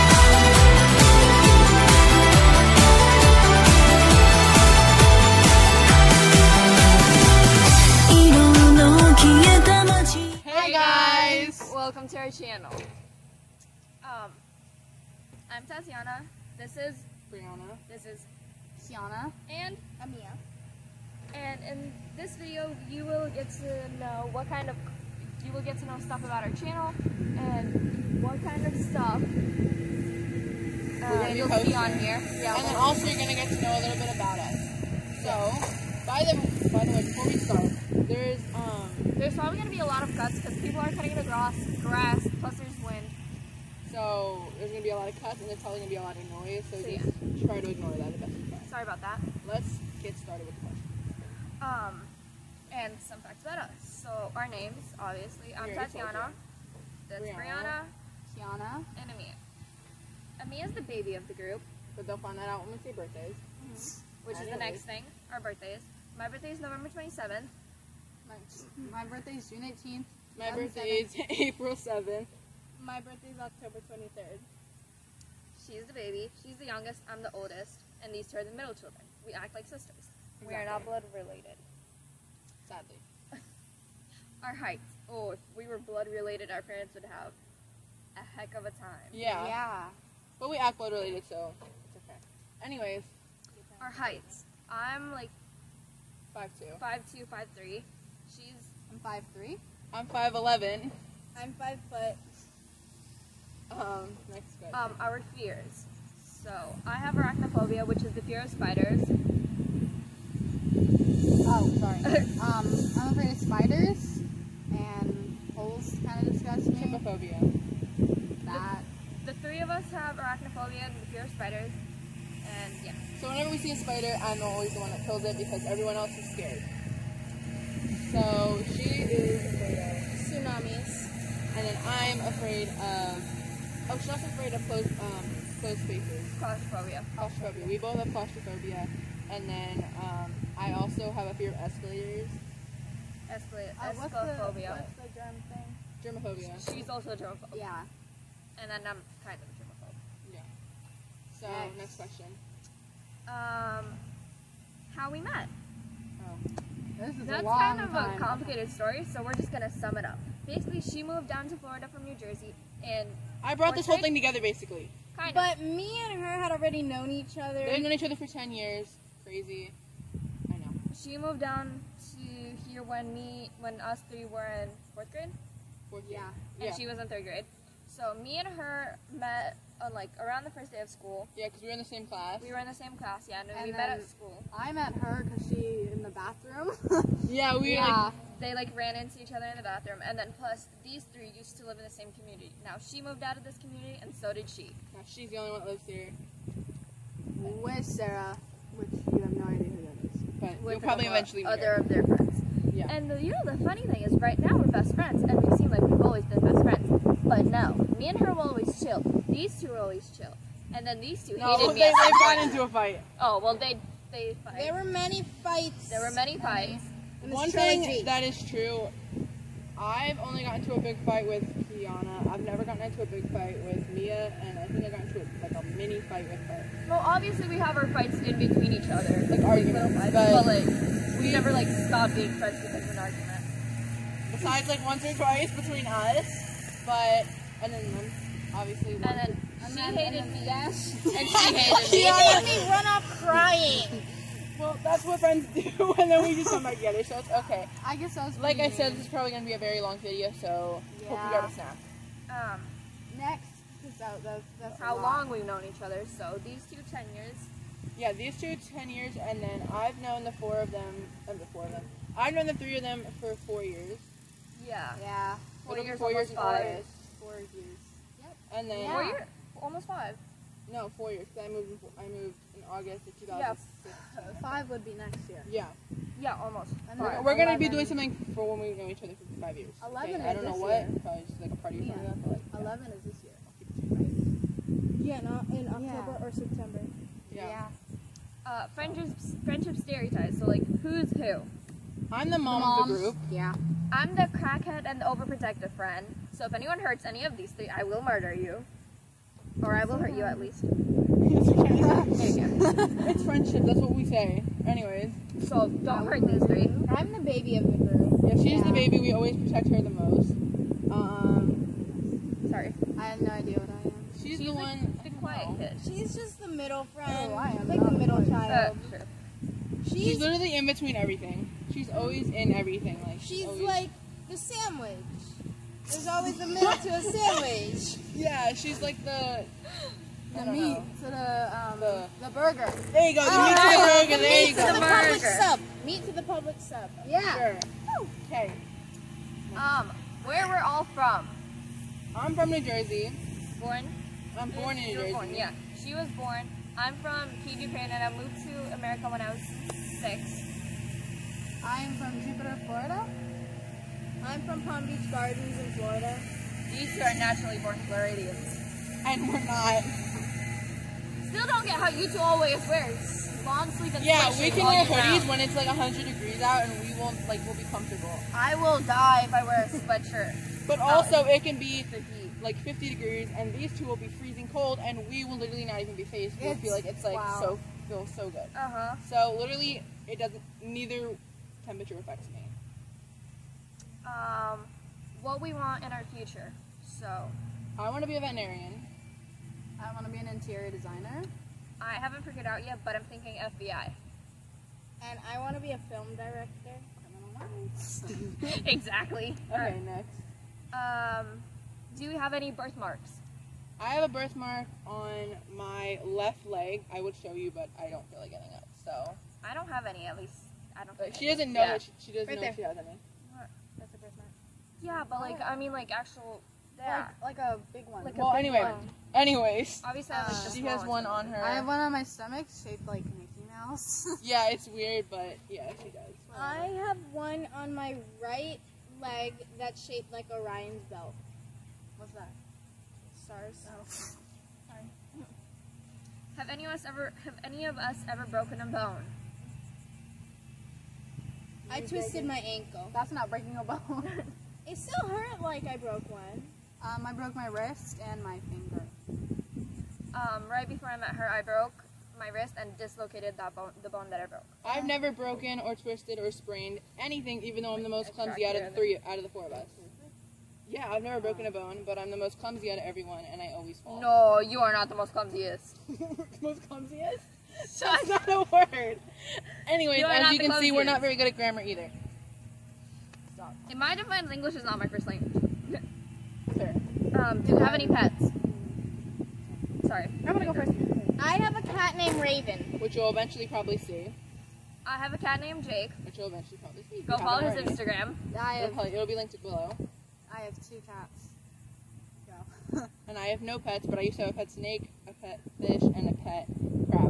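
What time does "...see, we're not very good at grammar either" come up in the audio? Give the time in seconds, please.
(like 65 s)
470 s.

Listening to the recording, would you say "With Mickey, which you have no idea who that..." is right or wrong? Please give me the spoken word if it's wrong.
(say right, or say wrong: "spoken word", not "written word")
wrong: "Sarah", not "Mickey".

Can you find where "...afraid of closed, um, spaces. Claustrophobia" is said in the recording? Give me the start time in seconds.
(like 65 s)
134 s.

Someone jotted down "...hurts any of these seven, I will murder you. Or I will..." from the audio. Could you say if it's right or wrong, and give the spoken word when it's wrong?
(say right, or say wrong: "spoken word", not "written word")
wrong: "three", not "seven".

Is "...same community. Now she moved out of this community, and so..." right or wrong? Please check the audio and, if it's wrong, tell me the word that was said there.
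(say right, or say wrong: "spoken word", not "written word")
right.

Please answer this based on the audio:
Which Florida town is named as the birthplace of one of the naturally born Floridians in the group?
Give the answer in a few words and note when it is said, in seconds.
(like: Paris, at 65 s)
Jupiter, at 352 s.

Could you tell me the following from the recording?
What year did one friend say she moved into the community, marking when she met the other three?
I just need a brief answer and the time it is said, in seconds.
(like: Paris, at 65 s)
2016, at 273 s.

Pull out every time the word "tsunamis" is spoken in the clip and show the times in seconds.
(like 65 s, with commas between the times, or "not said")
130 s.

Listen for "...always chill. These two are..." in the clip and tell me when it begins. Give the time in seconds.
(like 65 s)
208 s.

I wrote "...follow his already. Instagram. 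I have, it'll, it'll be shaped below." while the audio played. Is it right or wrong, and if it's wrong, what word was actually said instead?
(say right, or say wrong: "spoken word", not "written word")
wrong: "linked", not "shaped".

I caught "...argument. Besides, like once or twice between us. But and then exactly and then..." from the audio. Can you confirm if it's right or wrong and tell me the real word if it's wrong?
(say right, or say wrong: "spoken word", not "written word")
wrong: "obviously", not "exactly".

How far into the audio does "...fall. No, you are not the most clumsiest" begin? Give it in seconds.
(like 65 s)
463 s.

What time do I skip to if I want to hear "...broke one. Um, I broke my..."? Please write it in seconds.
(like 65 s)
445 s.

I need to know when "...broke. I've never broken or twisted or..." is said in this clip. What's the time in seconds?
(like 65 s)
454 s.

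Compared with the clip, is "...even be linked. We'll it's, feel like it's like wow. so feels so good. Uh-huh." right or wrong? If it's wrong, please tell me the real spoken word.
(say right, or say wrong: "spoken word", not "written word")
wrong: "faced", not "linked".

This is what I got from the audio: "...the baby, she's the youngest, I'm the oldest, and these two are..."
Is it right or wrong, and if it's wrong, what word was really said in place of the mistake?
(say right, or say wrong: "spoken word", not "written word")
right.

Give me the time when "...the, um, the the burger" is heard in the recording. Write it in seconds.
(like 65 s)
331 s.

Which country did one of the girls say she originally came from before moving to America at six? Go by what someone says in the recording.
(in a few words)
Japan.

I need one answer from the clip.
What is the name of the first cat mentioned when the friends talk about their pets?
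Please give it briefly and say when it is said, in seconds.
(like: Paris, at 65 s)
Raven, at 482 s.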